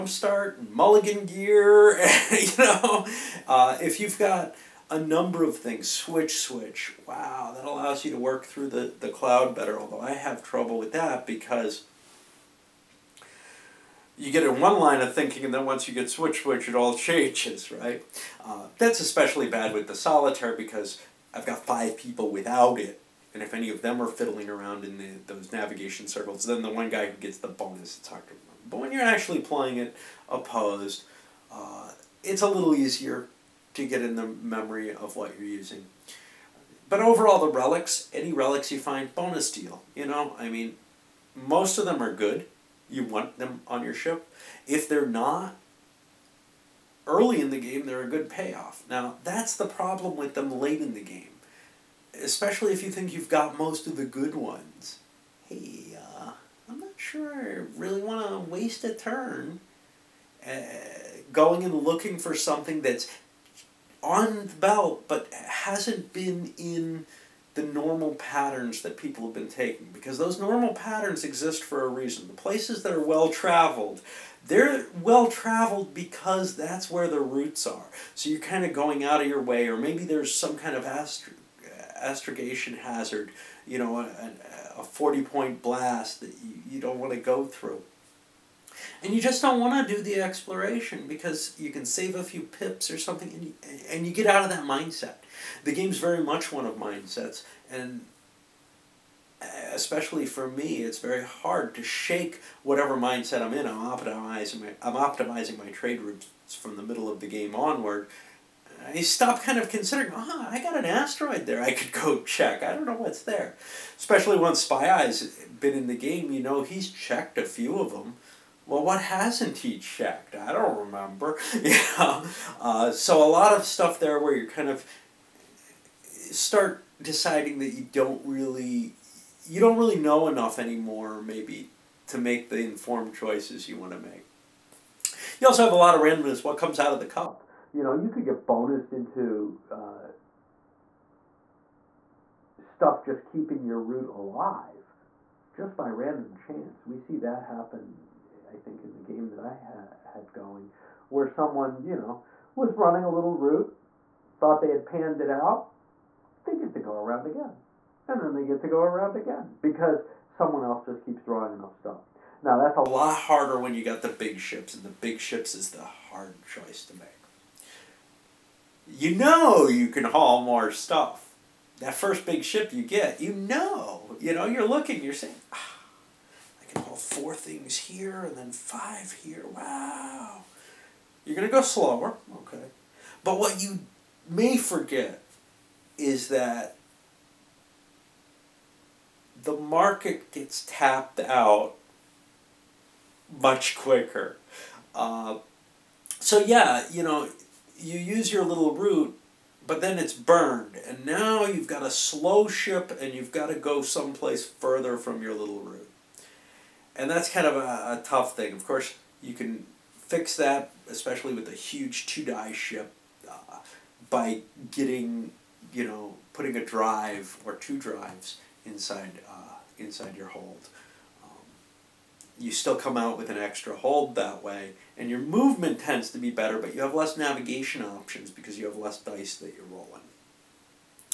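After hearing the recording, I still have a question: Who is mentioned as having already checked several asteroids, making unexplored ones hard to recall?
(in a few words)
Spy Eye.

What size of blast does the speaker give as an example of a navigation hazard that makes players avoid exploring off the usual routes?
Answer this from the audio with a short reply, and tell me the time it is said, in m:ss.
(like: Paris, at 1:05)
40 point, at 1:24.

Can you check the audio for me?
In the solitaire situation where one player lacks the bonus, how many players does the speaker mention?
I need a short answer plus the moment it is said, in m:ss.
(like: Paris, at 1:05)
5, at 0:21.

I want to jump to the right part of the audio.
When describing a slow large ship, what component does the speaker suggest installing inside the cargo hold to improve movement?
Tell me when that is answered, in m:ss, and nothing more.
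3:36.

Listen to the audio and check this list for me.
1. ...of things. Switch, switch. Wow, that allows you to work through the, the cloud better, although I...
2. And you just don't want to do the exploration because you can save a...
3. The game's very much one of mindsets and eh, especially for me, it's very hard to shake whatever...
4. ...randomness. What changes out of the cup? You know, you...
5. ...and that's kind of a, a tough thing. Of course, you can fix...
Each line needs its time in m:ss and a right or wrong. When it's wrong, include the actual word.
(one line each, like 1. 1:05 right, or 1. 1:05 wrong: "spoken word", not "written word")
1. 0:05 right
2. 1:29 right
3. 1:35 right
4. 2:16 wrong: "comes", not "changes"
5. 3:26 right.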